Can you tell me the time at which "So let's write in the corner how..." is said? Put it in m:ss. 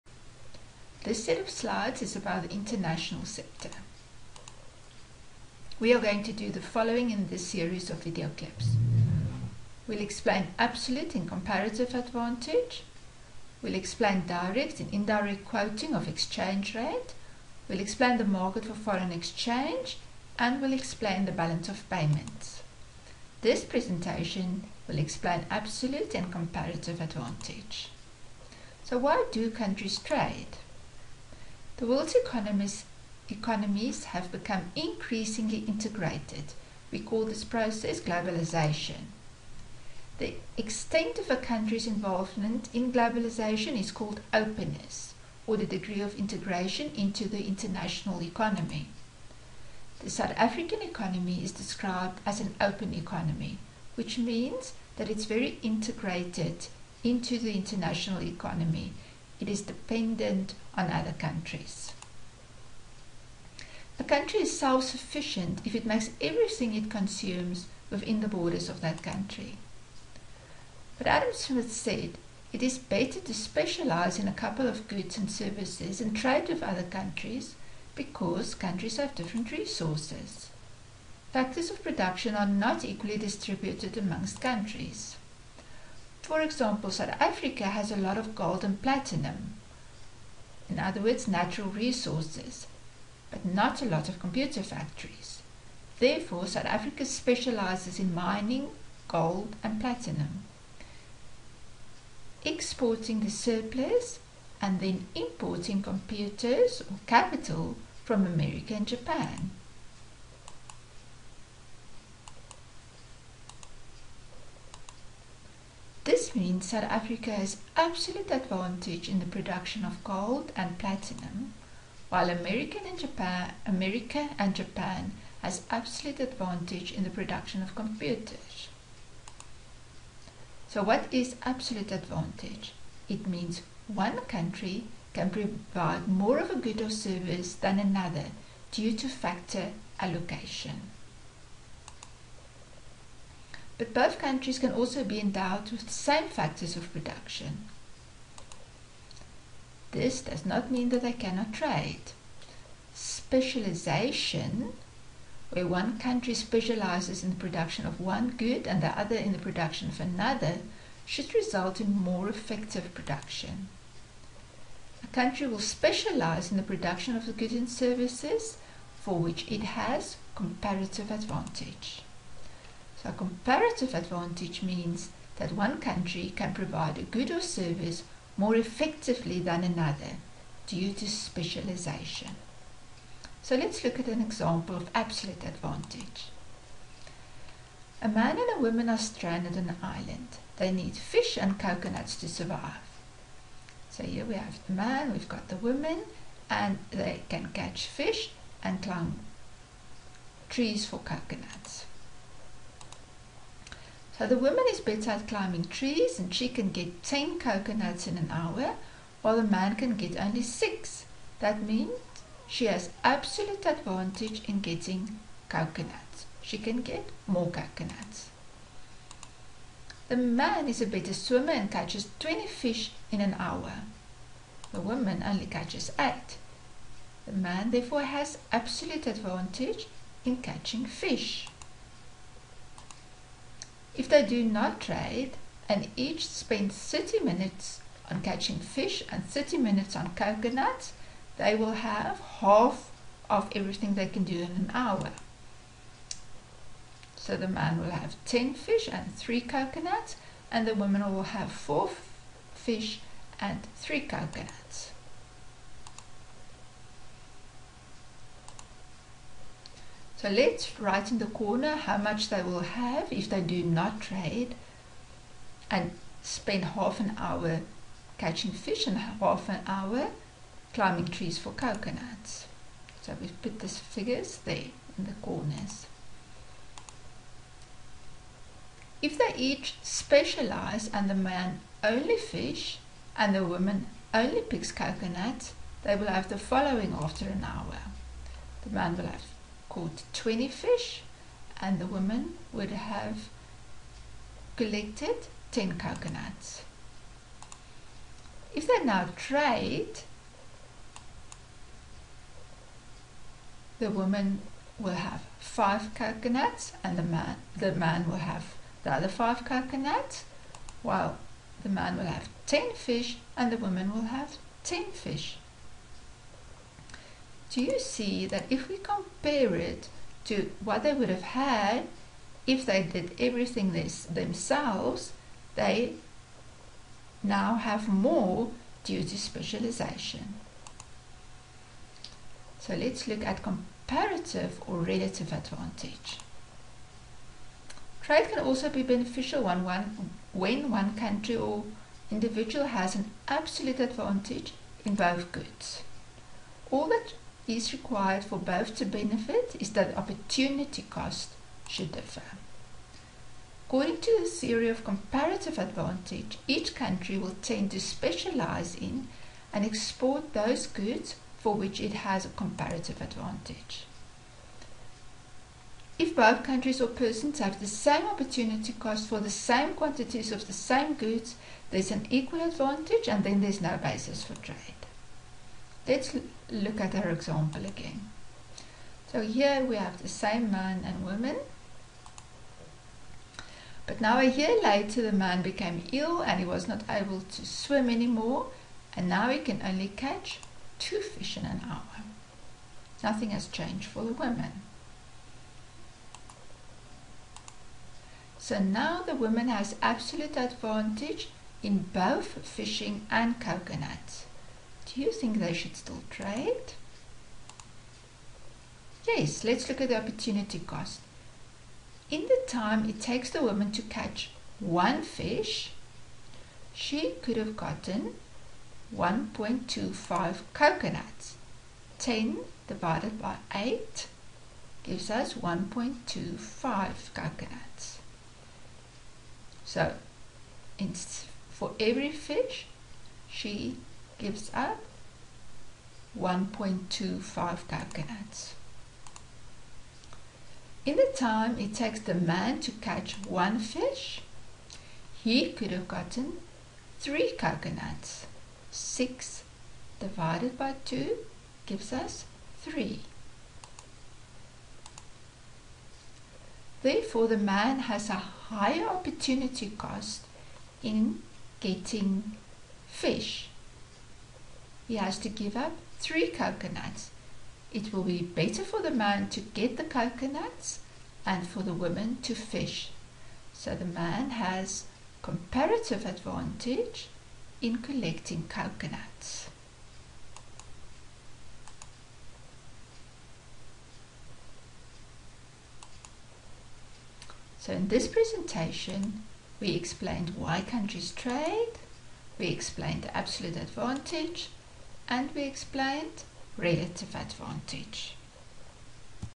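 4:20.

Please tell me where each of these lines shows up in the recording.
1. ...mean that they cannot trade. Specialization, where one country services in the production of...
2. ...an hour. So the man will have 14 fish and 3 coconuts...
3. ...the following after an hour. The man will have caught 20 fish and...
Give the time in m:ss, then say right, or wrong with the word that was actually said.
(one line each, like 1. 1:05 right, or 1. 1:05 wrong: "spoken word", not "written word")
1. 2:30 wrong: "specializes", not "services"
2. 4:04 wrong: "10", not "14"
3. 4:46 right.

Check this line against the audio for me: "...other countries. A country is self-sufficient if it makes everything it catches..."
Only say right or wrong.
wrong.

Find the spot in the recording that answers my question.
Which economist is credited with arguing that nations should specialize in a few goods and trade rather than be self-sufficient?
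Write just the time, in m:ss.
1:11.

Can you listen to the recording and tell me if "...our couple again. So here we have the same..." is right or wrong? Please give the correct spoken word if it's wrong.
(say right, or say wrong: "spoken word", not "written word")
wrong: "example", not "couple".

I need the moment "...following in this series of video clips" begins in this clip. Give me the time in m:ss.
0:06.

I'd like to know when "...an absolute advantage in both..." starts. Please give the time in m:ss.
5:42.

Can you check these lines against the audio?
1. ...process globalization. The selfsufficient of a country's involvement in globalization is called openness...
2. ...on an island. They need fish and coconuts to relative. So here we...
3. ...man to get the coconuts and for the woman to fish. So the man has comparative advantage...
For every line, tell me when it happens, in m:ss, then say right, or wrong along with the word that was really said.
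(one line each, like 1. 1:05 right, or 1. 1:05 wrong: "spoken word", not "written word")
1. 0:37 wrong: "extent", not "selfsufficient"
2. 3:09 wrong: "survive", not "relative"
3. 7:48 right.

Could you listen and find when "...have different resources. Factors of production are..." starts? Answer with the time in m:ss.
1:18.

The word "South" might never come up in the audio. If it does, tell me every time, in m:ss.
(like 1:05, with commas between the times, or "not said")
0:50, 1:26, 1:36, 1:56.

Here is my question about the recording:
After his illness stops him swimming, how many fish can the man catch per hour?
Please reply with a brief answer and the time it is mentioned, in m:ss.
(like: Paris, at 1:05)
2, at 6:30.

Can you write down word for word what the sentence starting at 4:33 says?
So we've put these figures there in the corners.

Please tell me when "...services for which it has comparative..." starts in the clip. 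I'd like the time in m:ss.
2:47.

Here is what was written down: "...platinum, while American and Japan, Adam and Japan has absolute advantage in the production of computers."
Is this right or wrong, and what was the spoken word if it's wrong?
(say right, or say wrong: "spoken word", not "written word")
wrong: "America", not "Adam".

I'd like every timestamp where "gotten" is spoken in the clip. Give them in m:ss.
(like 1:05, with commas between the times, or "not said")
6:57, 7:25.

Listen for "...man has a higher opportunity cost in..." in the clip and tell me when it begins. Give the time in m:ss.
7:37.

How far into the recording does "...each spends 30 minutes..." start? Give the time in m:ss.
3:55.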